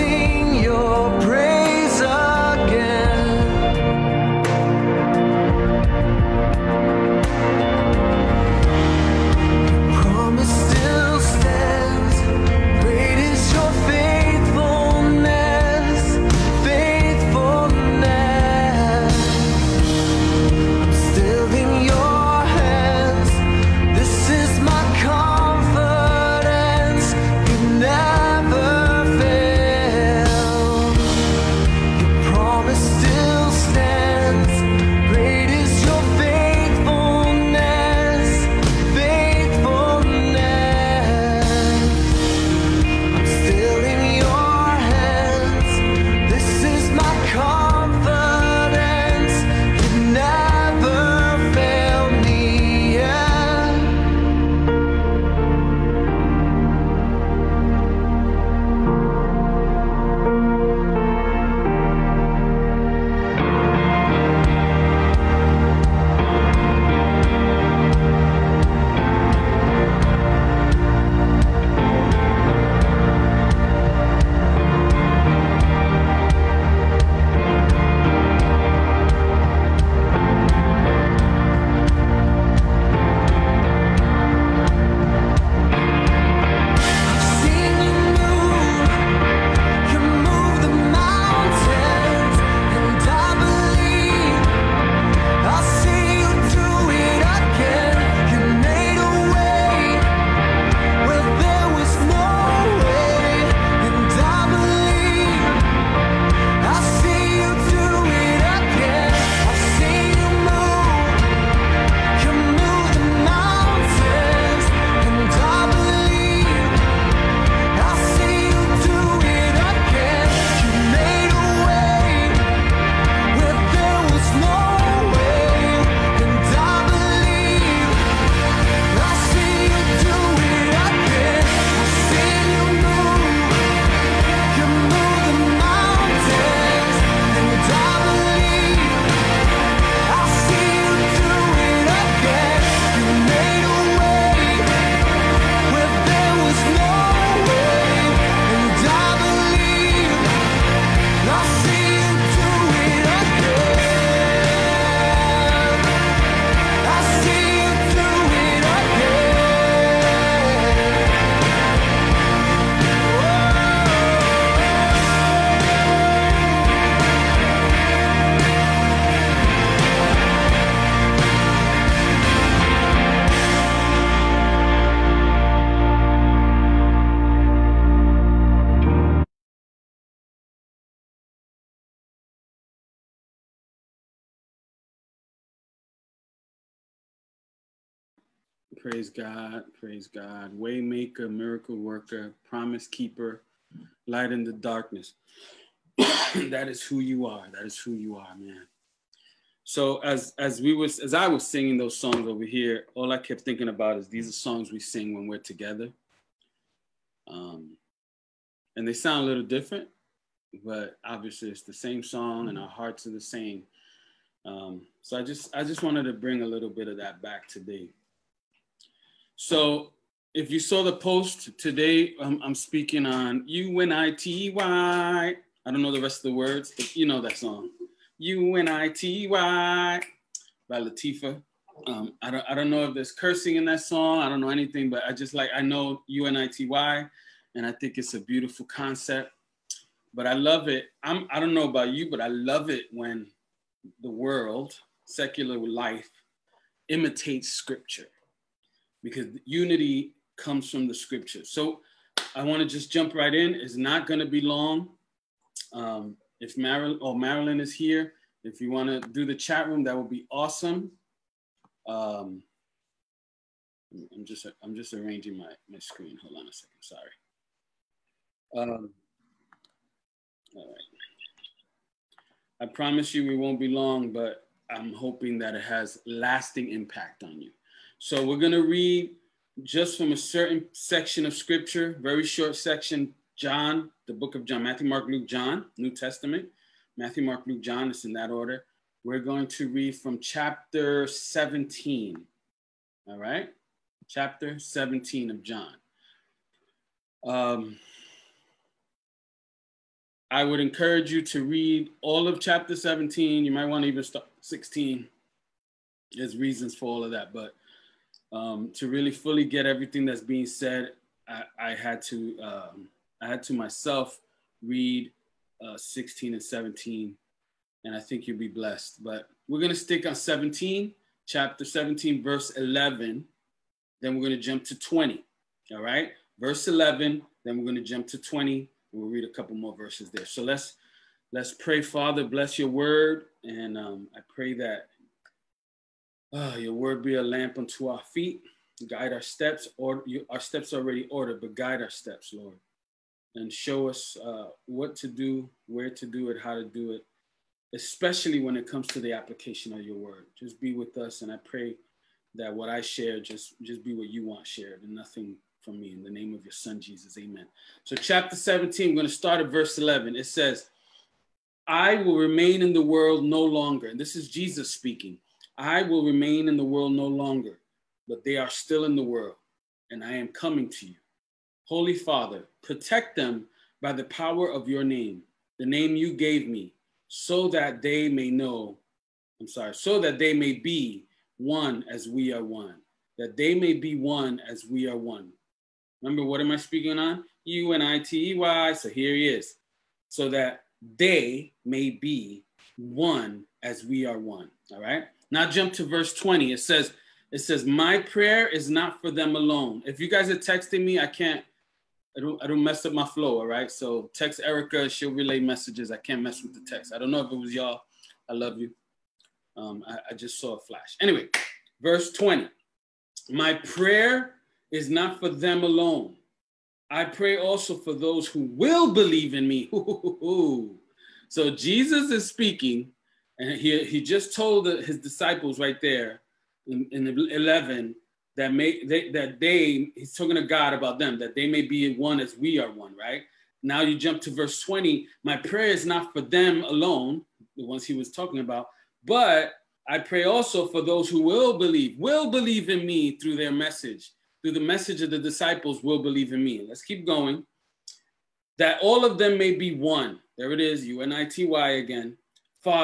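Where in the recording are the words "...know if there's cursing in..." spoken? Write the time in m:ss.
3:52.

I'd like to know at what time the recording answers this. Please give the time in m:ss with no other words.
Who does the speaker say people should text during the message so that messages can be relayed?
6:43.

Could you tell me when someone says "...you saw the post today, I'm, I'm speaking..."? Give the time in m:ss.
3:40.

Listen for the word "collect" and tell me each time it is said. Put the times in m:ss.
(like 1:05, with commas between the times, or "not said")
not said.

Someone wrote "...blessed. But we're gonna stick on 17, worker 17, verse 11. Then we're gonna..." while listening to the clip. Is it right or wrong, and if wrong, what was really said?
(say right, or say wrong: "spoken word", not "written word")
wrong: "chapter", not "worker".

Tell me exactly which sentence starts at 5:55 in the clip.
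In the name of your Son Jesus, Amen.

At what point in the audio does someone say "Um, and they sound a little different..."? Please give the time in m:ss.
3:27.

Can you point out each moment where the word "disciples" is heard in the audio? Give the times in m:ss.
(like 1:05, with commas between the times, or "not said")
7:04, 7:25.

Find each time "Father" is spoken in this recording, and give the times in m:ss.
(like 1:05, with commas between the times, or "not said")
5:31, 6:11.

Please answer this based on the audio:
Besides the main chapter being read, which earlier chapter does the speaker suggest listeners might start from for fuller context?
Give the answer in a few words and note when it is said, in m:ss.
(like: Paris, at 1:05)
16, at 5:03.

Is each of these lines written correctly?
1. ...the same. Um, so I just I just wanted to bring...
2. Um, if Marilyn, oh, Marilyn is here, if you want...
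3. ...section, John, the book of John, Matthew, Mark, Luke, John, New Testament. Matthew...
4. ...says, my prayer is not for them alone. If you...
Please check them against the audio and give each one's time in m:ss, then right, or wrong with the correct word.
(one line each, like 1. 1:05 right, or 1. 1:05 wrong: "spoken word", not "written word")
1. 3:33 right
2. 4:15 right
3. 4:42 right
4. 6:37 right.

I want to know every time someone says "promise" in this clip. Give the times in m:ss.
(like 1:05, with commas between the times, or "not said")
3:12, 4:32.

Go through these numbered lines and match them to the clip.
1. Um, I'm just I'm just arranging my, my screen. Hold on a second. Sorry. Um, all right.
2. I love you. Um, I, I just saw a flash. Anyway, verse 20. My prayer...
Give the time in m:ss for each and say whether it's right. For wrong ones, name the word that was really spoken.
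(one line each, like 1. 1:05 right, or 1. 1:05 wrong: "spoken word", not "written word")
1. 4:21 right
2. 6:48 right.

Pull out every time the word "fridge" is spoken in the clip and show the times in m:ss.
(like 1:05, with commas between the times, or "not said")
not said.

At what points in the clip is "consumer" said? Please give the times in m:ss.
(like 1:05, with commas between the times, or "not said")
not said.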